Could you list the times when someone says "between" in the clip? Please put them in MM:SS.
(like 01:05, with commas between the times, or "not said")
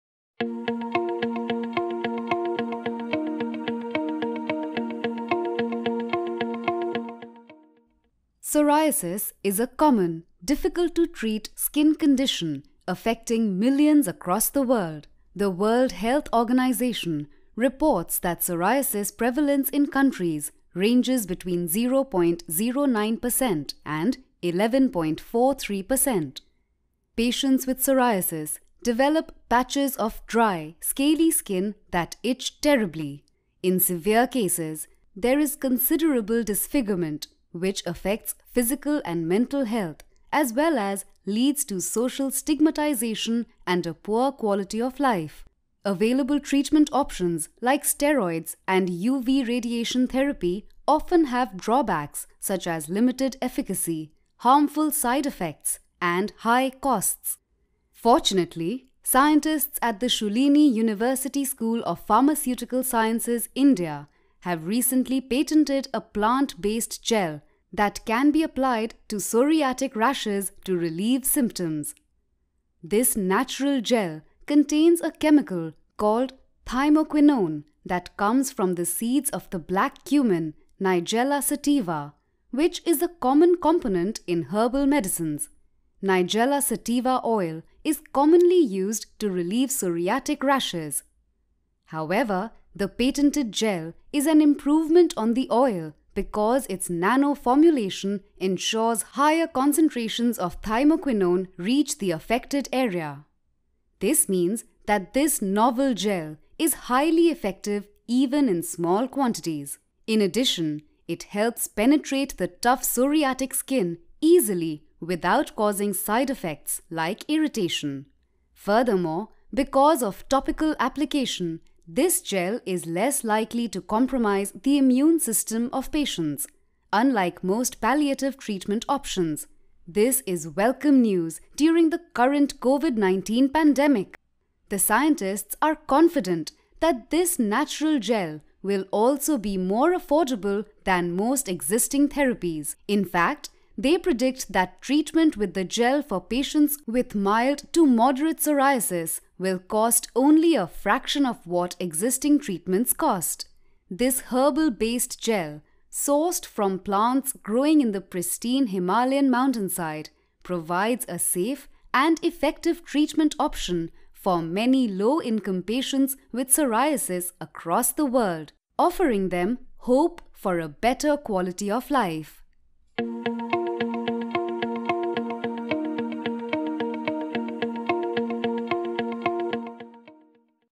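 00:21.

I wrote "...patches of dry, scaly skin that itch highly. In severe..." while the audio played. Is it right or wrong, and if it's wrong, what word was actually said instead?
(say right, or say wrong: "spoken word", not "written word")
wrong: "terribly", not "highly".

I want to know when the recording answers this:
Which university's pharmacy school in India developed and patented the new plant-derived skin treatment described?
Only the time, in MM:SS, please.
01:00.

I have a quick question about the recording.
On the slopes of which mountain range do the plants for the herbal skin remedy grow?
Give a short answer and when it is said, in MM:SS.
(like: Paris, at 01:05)
Himalayan, at 02:38.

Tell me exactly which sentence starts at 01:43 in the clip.
This means that this novel gel is highly effective even in small quantities.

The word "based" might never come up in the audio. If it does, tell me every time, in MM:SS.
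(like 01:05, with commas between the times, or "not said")
01:06, 02:34.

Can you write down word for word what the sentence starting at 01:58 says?
Furthermore, because of topical application, this gel is less likely to compromise the immune system of patients, unlike most palliative treatment options.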